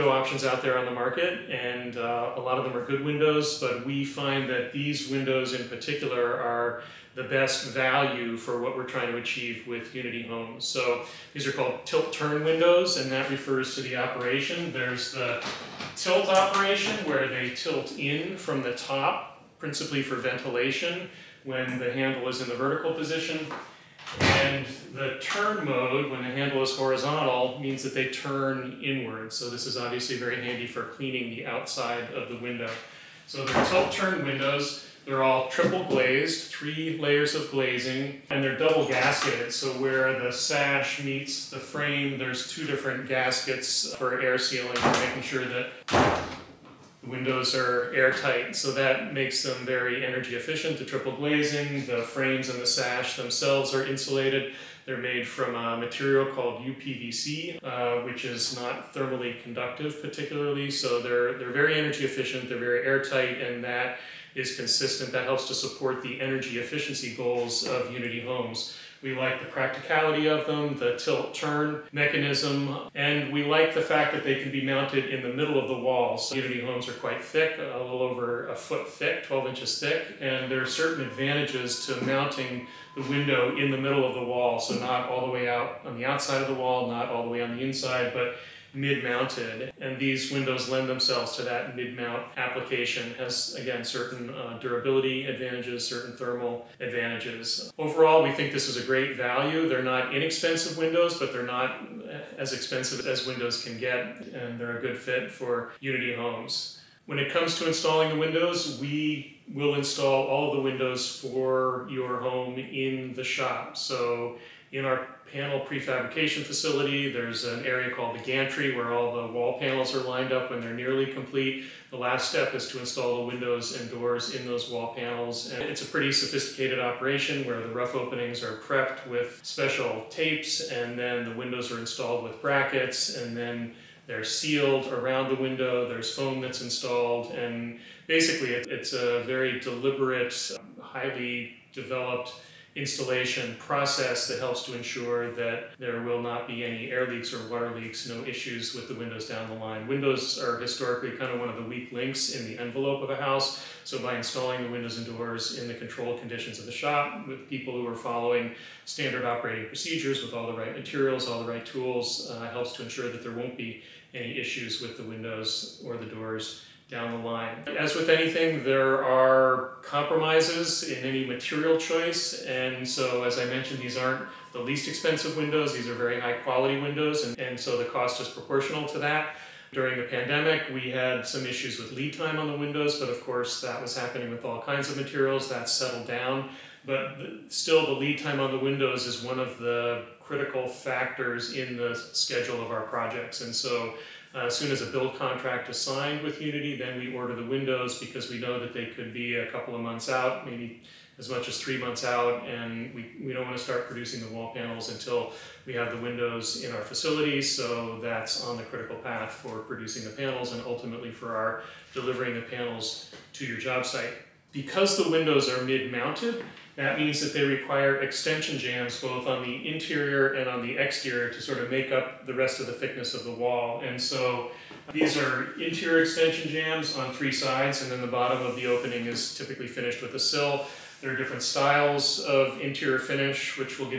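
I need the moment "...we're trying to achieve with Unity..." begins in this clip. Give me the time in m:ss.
0:08.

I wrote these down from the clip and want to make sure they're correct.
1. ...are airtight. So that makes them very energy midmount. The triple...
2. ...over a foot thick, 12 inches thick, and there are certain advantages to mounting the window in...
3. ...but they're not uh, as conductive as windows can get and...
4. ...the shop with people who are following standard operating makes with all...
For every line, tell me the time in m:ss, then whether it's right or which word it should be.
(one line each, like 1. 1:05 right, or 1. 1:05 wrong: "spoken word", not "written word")
1. 0:47 wrong: "efficient", not "midmount"
2. 1:18 right
3. 1:41 wrong: "expensive", not "conductive"
4. 2:36 wrong: "procedures", not "makes".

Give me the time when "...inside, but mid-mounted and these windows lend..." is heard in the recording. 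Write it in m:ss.
1:27.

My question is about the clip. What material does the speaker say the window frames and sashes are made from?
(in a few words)
UPVC.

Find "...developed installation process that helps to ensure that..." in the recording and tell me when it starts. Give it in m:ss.
2:21.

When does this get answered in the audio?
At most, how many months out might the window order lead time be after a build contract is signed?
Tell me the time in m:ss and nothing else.
3:21.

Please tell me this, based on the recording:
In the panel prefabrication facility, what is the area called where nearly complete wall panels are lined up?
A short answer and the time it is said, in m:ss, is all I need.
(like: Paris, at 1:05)
the gantry, at 1:58.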